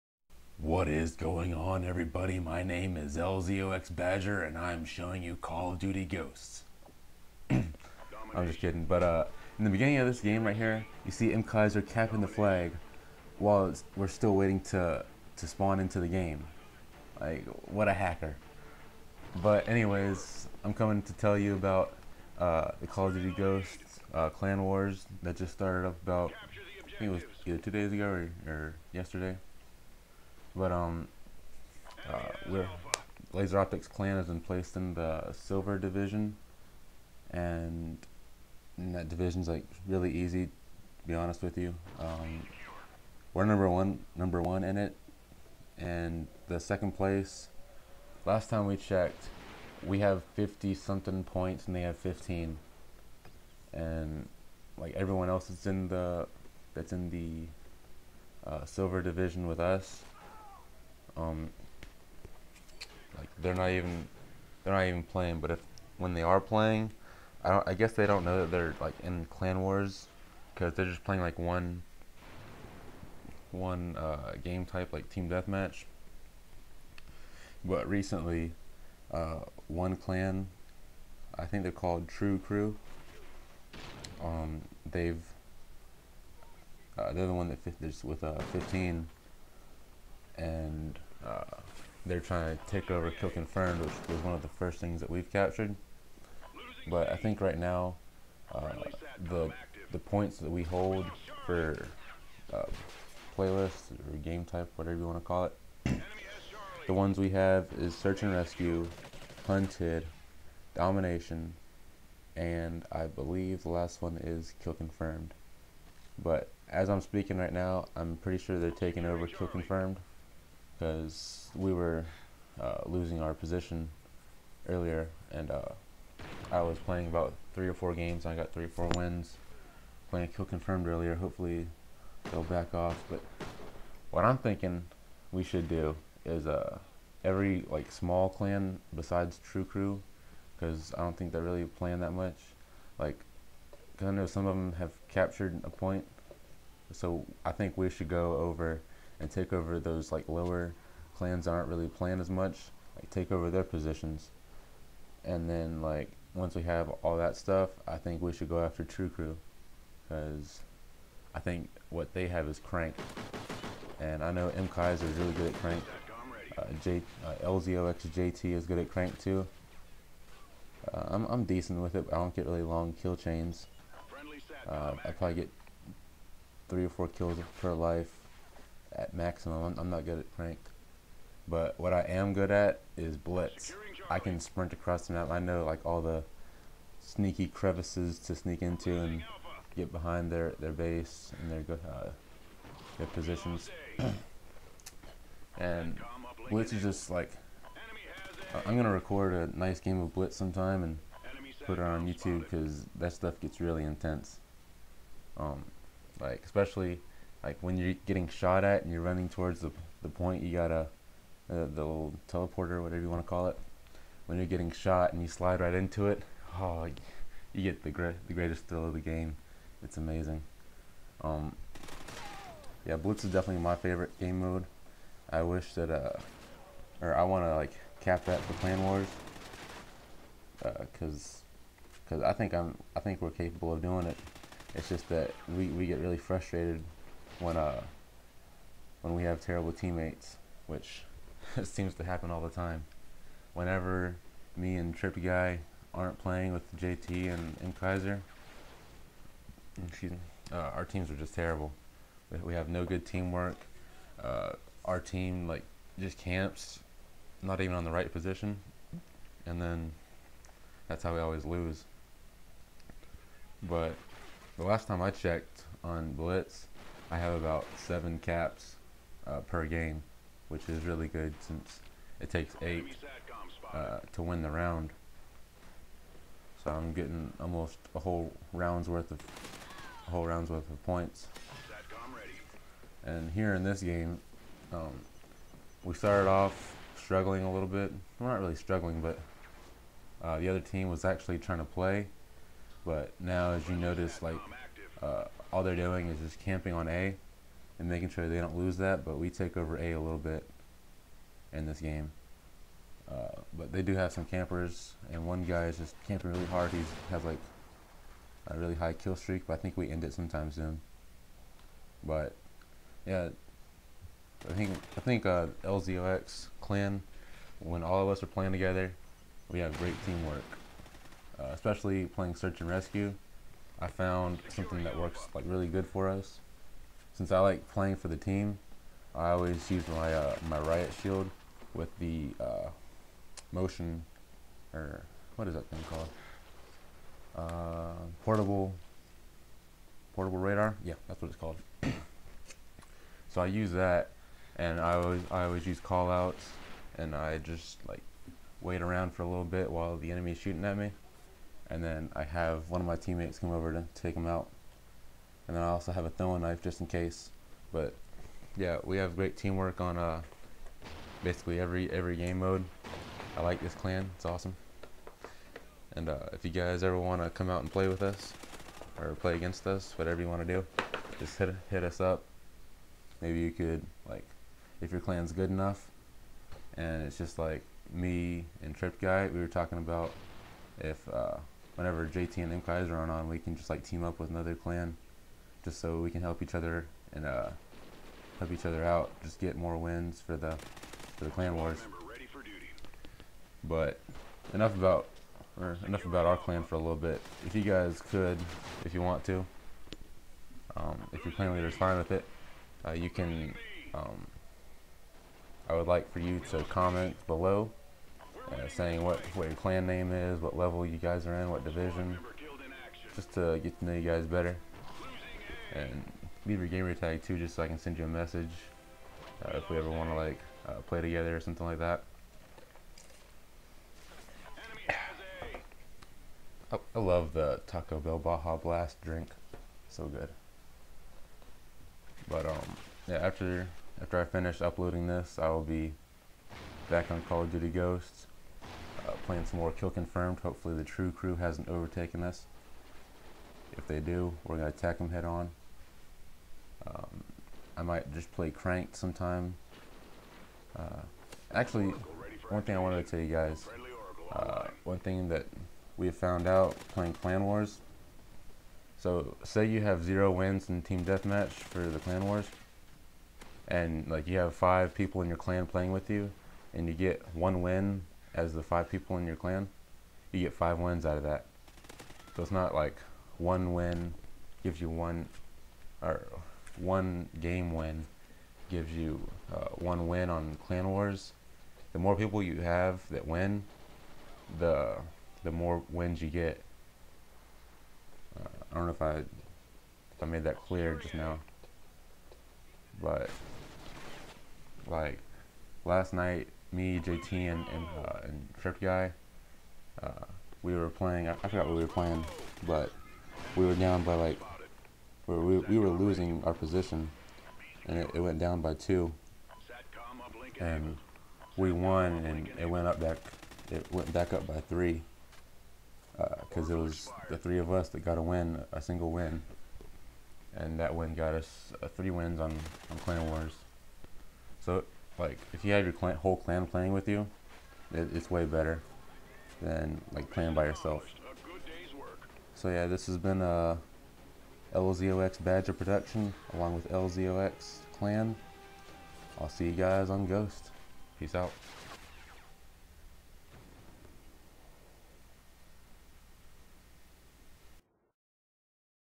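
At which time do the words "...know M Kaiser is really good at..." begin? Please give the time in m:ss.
2:44.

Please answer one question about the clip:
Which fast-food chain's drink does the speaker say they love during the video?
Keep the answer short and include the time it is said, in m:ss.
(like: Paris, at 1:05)
Taco Bell, at 7:07.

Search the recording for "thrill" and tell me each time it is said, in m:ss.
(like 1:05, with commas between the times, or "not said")
3:38.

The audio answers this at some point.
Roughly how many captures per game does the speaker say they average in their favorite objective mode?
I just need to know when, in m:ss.
4:27.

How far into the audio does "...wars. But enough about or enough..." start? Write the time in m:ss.
6:31.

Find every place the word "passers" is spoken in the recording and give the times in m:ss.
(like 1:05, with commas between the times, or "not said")
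not said.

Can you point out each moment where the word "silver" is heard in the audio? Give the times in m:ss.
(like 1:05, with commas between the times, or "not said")
0:35, 0:58.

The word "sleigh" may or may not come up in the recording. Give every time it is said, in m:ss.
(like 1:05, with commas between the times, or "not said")
not said.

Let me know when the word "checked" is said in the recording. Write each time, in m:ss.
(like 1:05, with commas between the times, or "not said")
0:48, 4:25.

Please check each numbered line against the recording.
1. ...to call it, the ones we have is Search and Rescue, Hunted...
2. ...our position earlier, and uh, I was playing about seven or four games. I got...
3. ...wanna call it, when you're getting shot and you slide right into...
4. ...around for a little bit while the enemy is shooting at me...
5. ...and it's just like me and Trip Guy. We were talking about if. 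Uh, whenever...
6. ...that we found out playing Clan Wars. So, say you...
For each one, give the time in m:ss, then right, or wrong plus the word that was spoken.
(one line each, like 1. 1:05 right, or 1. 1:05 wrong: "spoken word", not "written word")
1. 1:45 right
2. 2:03 wrong: "three", not "seven"
3. 3:33 right
4. 5:48 right
5. 6:16 right
6. 7:35 right.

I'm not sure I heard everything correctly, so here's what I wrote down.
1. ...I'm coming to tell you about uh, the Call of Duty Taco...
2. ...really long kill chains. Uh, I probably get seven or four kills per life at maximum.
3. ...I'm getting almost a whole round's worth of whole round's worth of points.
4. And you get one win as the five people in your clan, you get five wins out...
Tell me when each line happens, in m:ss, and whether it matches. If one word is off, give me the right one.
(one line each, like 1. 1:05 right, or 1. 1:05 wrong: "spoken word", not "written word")
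1. 0:20 wrong: "Ghosts", not "Taco"
2. 2:52 wrong: "three", not "seven"
3. 4:36 right
4. 7:46 right.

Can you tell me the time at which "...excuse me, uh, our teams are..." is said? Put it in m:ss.
4:09.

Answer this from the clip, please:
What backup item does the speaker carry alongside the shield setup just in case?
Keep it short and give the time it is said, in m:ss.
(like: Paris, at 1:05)
Throwing knife, at 5:56.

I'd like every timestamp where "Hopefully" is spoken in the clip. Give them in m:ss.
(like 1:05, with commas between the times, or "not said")
2:11, 7:20.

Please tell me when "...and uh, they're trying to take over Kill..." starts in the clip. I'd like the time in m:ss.
1:30.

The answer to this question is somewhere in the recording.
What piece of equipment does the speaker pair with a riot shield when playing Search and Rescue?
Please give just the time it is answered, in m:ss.
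5:38.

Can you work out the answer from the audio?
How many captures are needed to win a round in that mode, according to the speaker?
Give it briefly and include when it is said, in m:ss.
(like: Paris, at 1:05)
8, at 4:32.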